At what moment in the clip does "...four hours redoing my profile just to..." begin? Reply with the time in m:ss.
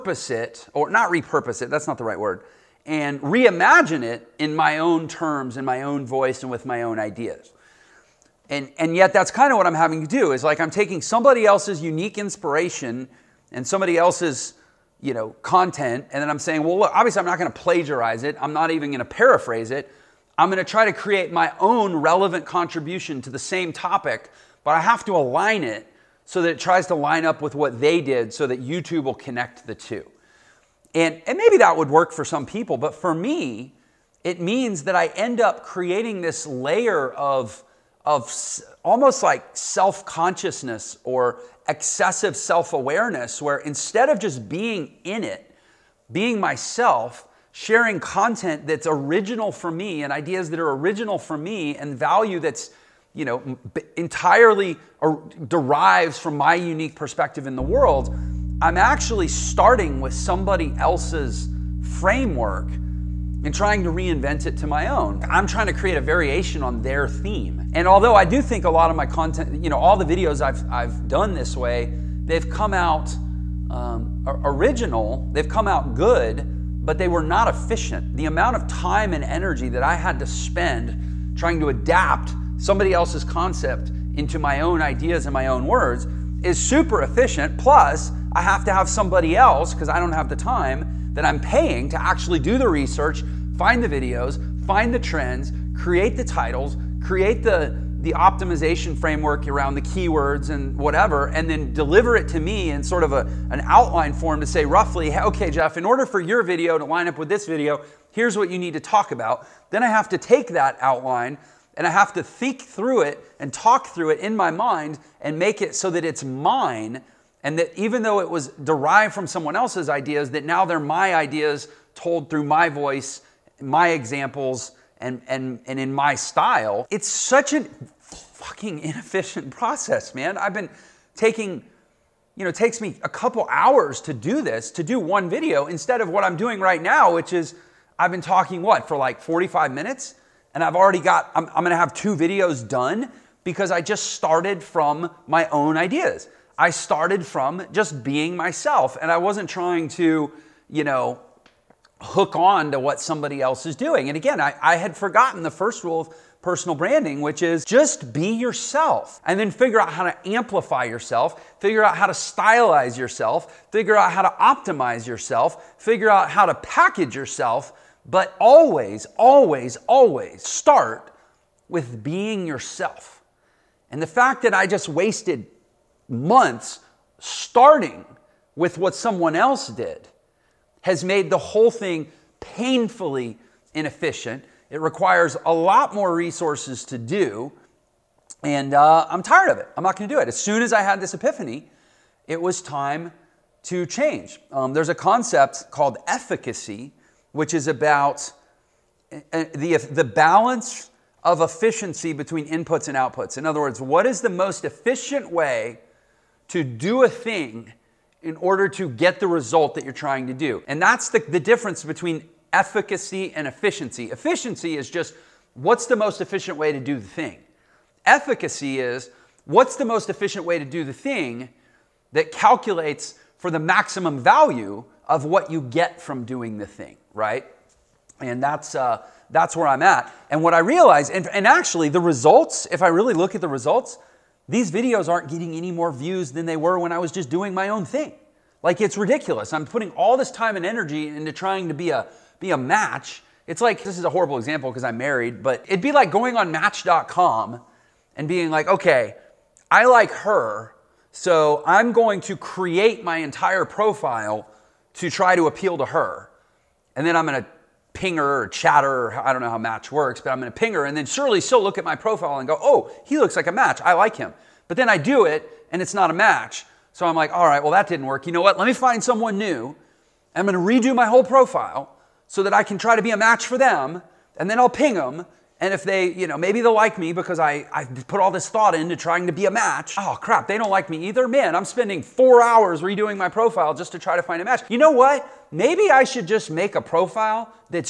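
4:42.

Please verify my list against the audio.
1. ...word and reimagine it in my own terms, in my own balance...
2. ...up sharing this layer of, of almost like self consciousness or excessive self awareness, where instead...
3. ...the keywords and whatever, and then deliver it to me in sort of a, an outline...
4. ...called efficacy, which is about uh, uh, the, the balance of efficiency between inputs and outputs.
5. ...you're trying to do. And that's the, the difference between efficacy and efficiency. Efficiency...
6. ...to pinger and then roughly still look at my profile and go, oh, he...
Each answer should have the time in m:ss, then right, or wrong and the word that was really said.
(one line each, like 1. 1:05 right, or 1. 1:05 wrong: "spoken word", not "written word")
1. 0:02 wrong: "voice", not "balance"
2. 0:35 wrong: "creating", not "sharing"
3. 1:39 right
4. 3:15 right
5. 3:29 right
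6. 4:20 wrong: "surely", not "roughly".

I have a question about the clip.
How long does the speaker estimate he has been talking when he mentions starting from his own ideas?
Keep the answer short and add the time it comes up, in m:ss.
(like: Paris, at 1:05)
45 minutes, at 2:19.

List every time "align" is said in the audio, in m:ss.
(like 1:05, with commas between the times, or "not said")
0:25.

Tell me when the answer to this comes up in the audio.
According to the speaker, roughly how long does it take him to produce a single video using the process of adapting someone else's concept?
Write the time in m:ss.
2:13.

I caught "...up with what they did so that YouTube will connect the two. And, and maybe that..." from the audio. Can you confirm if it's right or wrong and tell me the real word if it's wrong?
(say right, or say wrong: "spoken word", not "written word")
right.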